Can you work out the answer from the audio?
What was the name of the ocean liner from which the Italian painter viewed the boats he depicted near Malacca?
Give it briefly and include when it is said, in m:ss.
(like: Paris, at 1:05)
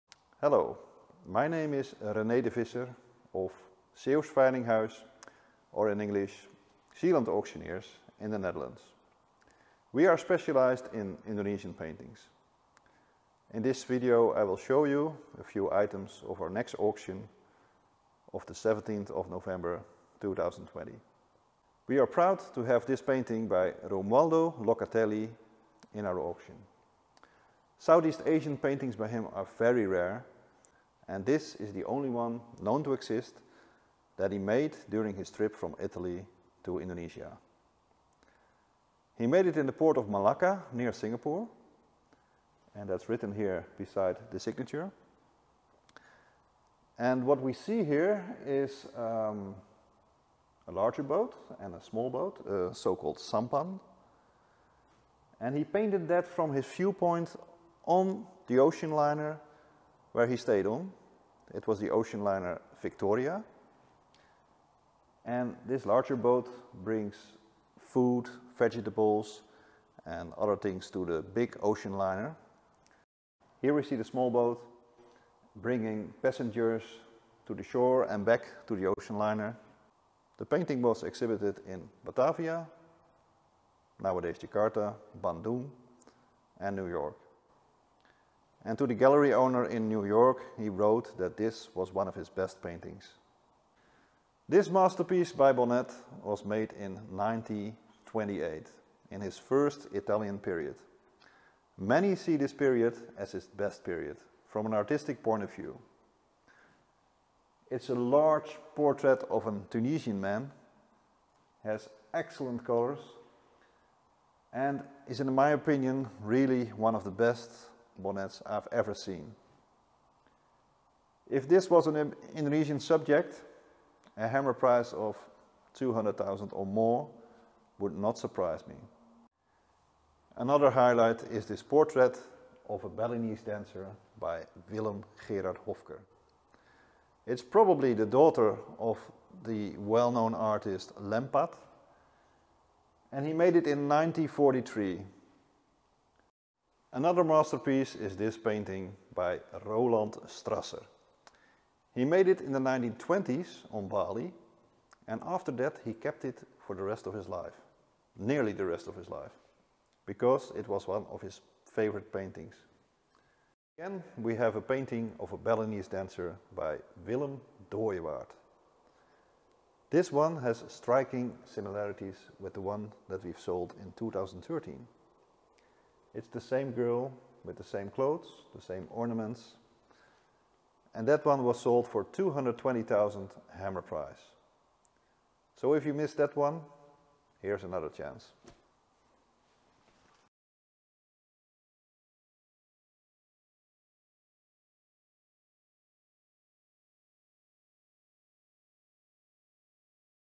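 Victoria, at 1:02.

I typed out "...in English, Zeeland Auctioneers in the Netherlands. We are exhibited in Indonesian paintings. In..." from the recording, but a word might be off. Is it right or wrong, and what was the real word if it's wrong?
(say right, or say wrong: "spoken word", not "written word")
wrong: "specialized", not "exhibited".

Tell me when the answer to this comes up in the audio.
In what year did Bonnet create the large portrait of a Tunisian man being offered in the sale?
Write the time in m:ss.
1:37.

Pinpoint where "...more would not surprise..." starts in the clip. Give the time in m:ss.
2:06.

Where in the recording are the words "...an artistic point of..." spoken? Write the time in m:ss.
1:44.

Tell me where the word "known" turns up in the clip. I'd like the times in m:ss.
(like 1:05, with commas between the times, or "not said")
0:32, 2:19.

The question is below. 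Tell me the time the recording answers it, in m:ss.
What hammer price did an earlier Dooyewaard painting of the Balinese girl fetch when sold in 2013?
3:02.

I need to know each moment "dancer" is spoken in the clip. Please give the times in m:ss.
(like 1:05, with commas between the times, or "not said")
2:13, 2:45.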